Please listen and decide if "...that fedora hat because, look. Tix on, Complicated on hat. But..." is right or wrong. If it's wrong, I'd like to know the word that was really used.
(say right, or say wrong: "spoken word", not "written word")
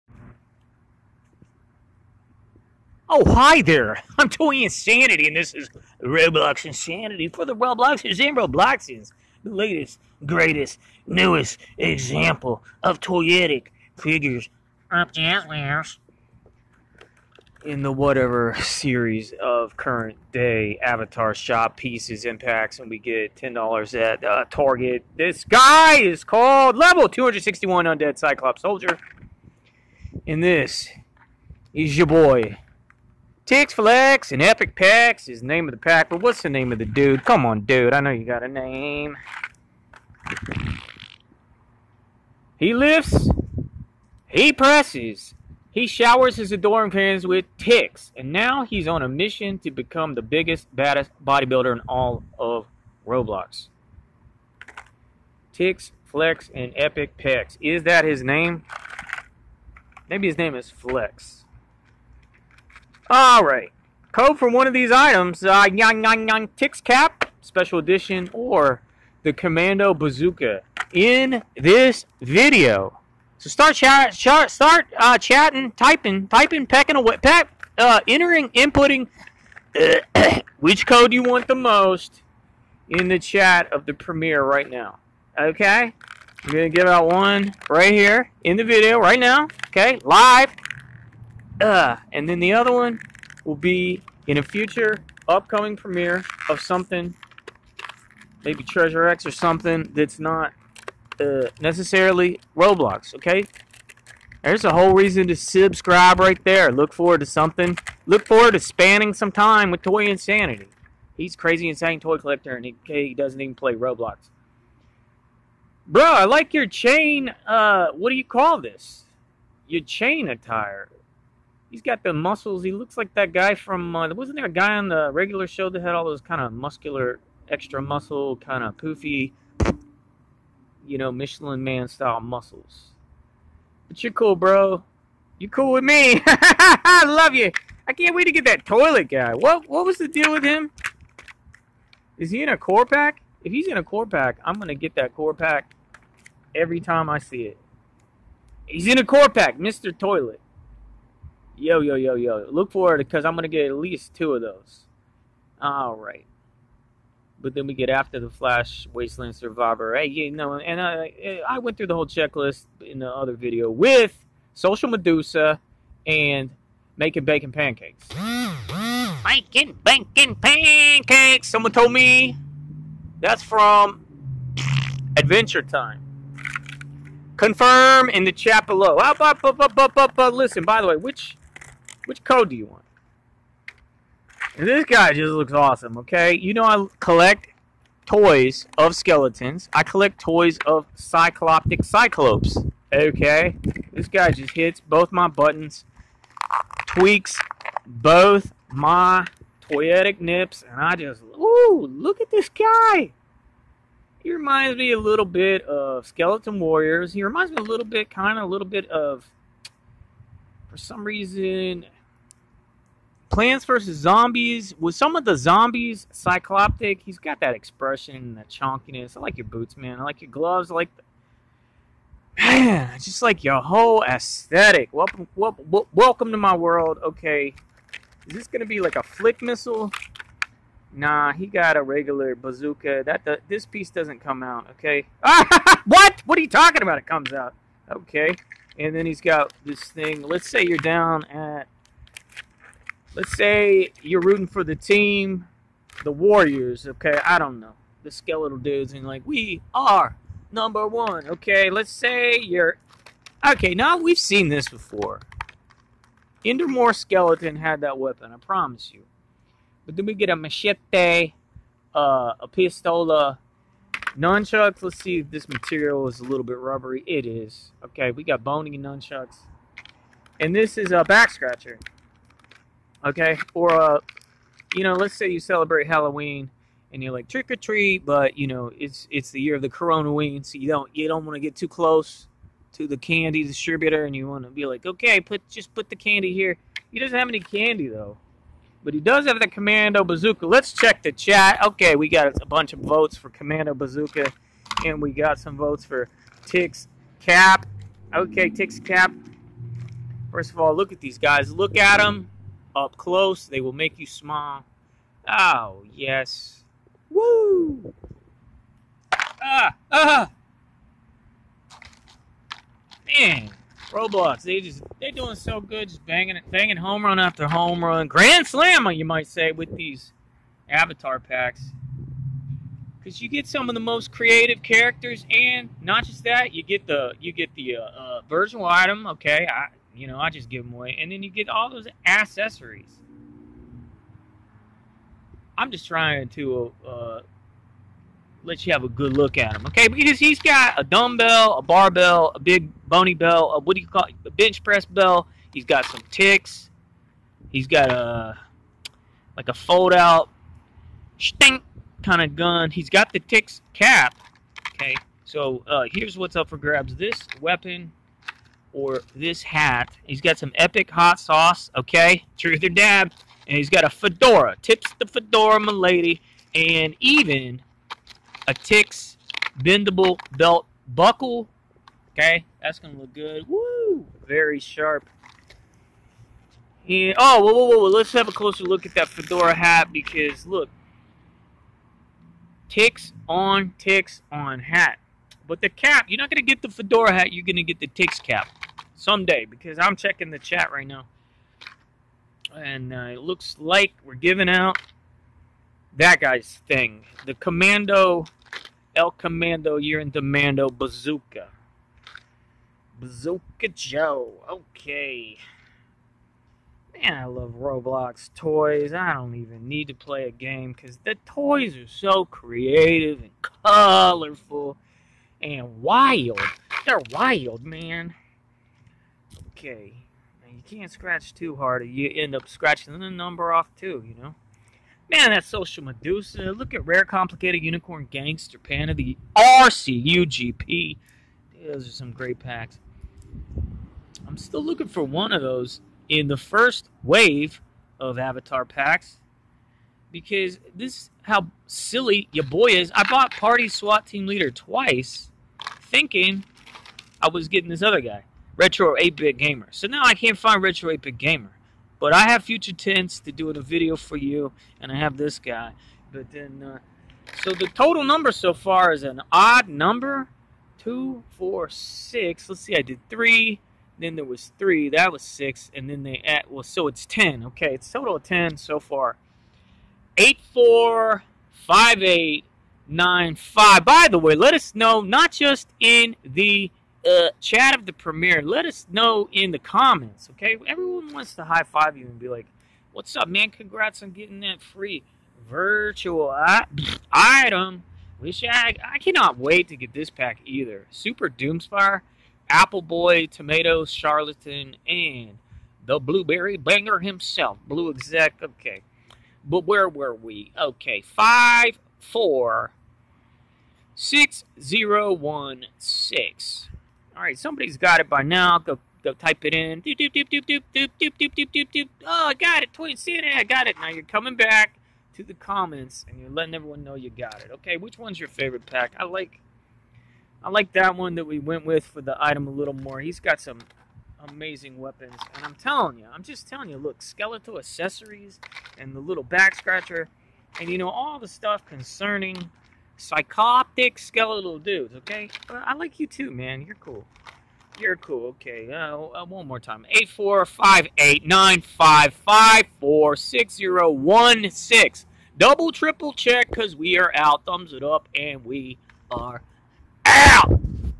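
wrong: "Tix", not "Complicated".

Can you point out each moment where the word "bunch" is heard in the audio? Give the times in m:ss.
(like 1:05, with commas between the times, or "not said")
4:52.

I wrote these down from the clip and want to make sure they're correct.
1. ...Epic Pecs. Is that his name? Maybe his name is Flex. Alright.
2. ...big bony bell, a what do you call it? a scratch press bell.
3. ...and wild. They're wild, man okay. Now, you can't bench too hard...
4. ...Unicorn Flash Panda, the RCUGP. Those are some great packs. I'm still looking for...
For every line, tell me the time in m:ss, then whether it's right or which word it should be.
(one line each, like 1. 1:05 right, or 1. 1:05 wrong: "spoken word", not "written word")
1. 0:56 right
2. 5:42 wrong: "bench", not "scratch"
3. 6:55 wrong: "scratch", not "bench"
4. 7:07 wrong: "Gangster", not "Flash".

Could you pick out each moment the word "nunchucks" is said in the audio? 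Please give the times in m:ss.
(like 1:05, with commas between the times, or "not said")
4:24, 4:28.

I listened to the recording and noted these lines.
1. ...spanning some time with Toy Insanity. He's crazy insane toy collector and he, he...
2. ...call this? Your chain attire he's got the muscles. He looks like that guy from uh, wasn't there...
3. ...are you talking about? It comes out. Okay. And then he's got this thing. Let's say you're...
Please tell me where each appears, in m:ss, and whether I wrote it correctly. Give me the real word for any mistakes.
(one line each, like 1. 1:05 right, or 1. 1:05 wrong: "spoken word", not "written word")
1. 1:48 right
2. 1:58 right
3. 3:56 right.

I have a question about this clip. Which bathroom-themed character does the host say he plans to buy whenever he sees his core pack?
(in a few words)
Mr. Toilet.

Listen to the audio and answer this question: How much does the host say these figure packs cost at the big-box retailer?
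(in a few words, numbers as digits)
$10.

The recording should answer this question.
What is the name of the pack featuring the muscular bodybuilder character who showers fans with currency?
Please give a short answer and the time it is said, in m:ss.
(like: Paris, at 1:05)
Tix Flex and Epic Pecs, at 0:33.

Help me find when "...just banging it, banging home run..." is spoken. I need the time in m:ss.
5:15.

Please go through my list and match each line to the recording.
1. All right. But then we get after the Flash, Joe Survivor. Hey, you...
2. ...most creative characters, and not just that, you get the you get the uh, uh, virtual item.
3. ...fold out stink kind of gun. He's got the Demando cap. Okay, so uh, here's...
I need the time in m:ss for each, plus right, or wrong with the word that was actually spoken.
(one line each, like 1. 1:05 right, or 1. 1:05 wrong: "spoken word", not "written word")
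1. 2:35 wrong: "Wasteland", not "Joe"
2. 5:23 right
3. 5:49 wrong: "Tix", not "Demando".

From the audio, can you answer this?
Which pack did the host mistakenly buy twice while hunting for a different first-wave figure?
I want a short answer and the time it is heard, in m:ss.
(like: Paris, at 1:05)
Party SWAT Team Leader, at 7:23.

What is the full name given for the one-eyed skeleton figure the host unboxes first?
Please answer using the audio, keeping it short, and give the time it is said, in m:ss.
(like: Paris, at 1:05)
Level 261 Undead Cyclops Soldier, at 0:26.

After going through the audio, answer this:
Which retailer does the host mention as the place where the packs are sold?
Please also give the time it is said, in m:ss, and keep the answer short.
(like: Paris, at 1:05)
Target, at 0:24.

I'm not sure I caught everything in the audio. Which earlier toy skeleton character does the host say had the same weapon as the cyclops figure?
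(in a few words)
Endermore Skeleton.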